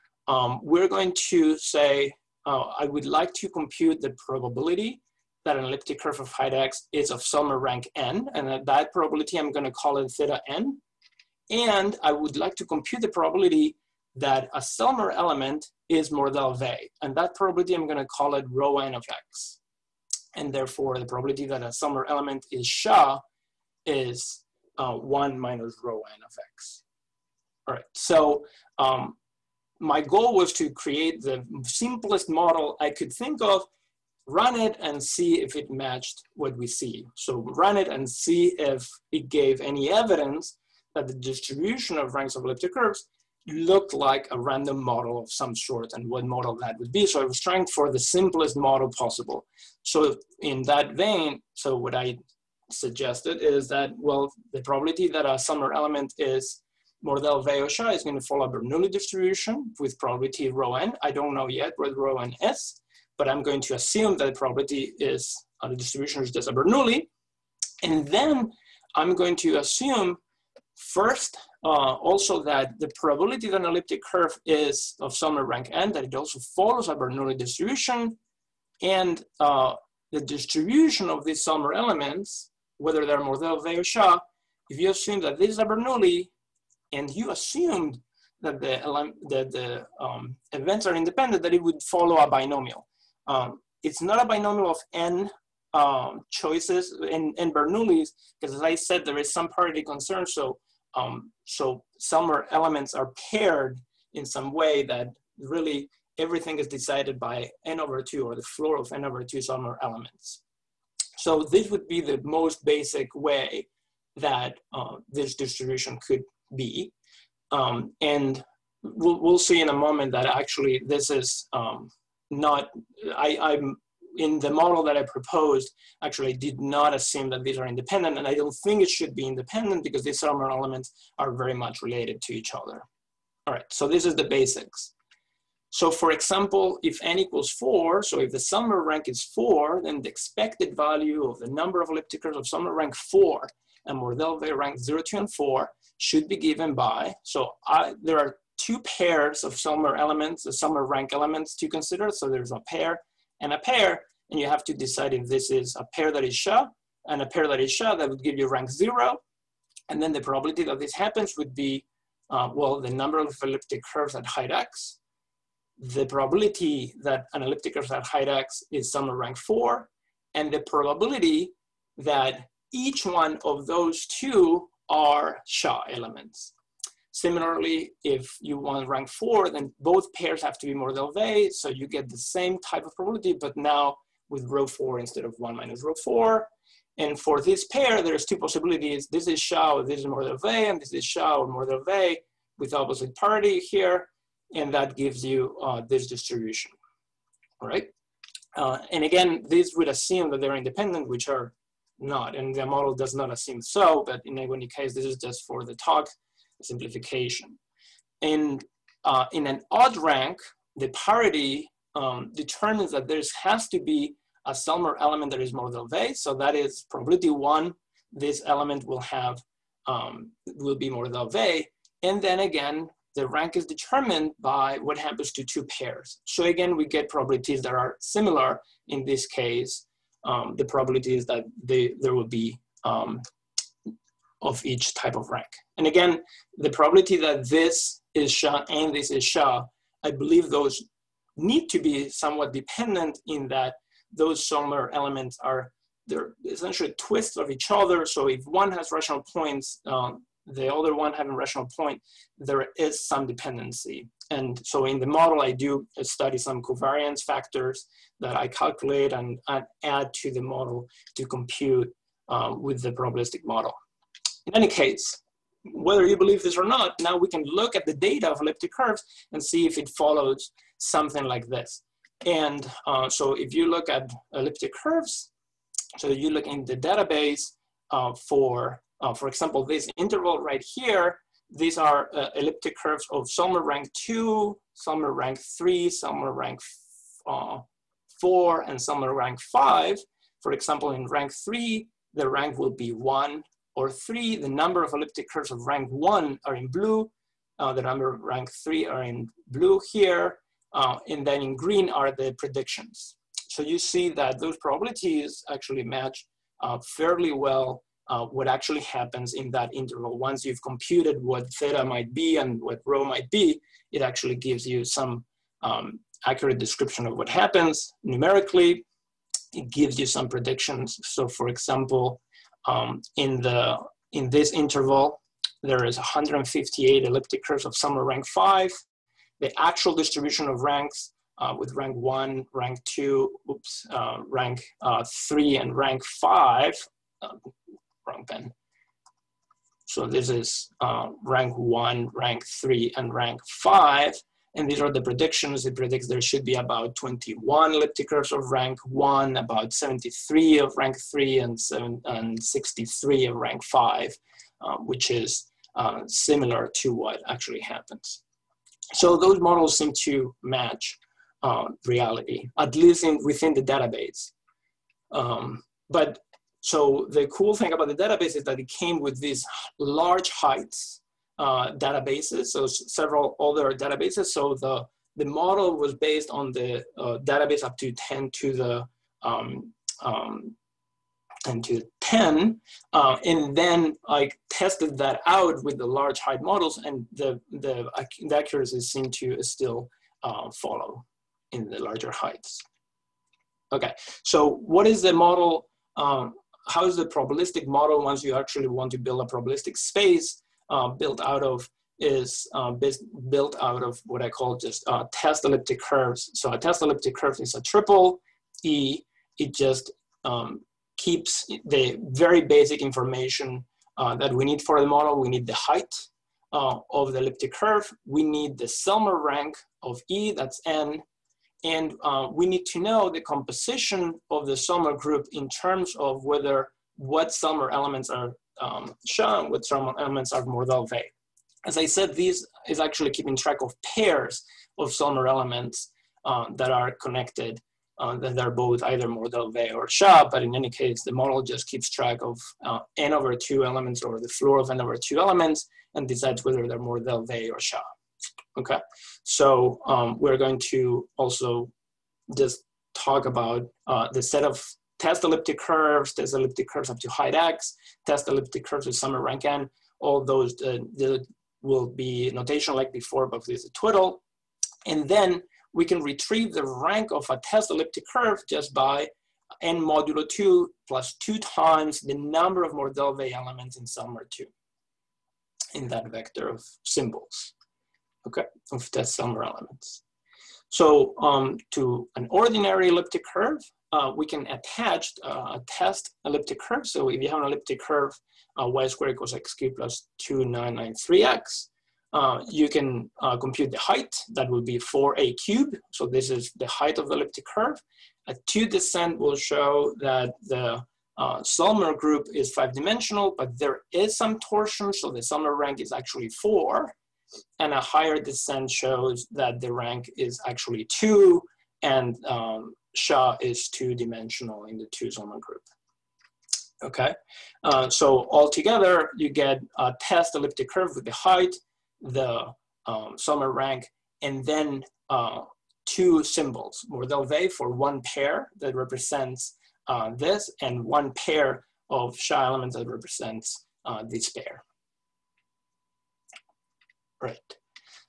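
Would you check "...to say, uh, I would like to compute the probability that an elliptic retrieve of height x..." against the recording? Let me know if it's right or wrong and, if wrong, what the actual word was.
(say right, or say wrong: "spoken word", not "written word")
wrong: "curve", not "retrieve".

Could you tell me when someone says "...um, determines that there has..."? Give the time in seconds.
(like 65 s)
211 s.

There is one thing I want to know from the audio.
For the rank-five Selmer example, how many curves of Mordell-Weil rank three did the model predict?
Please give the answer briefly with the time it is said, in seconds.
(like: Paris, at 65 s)
73, at 349 s.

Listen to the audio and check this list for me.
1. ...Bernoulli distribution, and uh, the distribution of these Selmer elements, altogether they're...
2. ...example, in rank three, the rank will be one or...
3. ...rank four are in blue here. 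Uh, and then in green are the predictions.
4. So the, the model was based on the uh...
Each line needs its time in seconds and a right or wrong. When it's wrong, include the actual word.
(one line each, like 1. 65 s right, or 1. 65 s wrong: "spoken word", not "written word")
1. 76 s wrong: "whether", not "altogether"
2. 290 s right
3. 298 s wrong: "three", not "four"
4. 374 s right.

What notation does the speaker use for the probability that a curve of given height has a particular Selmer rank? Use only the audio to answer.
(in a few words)
theta n.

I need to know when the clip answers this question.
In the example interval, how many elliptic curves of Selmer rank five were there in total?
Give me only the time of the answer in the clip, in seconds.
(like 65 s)
325 s.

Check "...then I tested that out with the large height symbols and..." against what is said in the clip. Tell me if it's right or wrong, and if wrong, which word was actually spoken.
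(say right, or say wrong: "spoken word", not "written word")
wrong: "models", not "symbols".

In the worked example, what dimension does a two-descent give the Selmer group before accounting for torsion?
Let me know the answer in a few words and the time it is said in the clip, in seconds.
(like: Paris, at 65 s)
5, at 502 s.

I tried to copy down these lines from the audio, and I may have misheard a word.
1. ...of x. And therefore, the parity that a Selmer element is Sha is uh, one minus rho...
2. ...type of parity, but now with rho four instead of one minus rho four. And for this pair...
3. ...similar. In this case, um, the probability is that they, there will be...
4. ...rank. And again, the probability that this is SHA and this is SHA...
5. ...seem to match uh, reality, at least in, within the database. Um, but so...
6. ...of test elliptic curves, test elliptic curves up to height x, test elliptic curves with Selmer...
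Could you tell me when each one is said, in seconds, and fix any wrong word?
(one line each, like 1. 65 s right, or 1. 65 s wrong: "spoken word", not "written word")
1. 18 s wrong: "probability", not "parity"
2. 182 s wrong: "probability", not "parity"
3. 227 s right
4. 235 s right
5. 359 s right
6. 454 s right.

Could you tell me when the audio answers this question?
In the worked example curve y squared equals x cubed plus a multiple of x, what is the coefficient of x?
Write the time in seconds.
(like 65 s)
490 s.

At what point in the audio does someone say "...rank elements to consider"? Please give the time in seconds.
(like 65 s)
150 s.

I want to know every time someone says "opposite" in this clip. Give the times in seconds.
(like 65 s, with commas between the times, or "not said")
192 s.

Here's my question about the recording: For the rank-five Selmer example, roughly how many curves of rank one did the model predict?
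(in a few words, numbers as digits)
21.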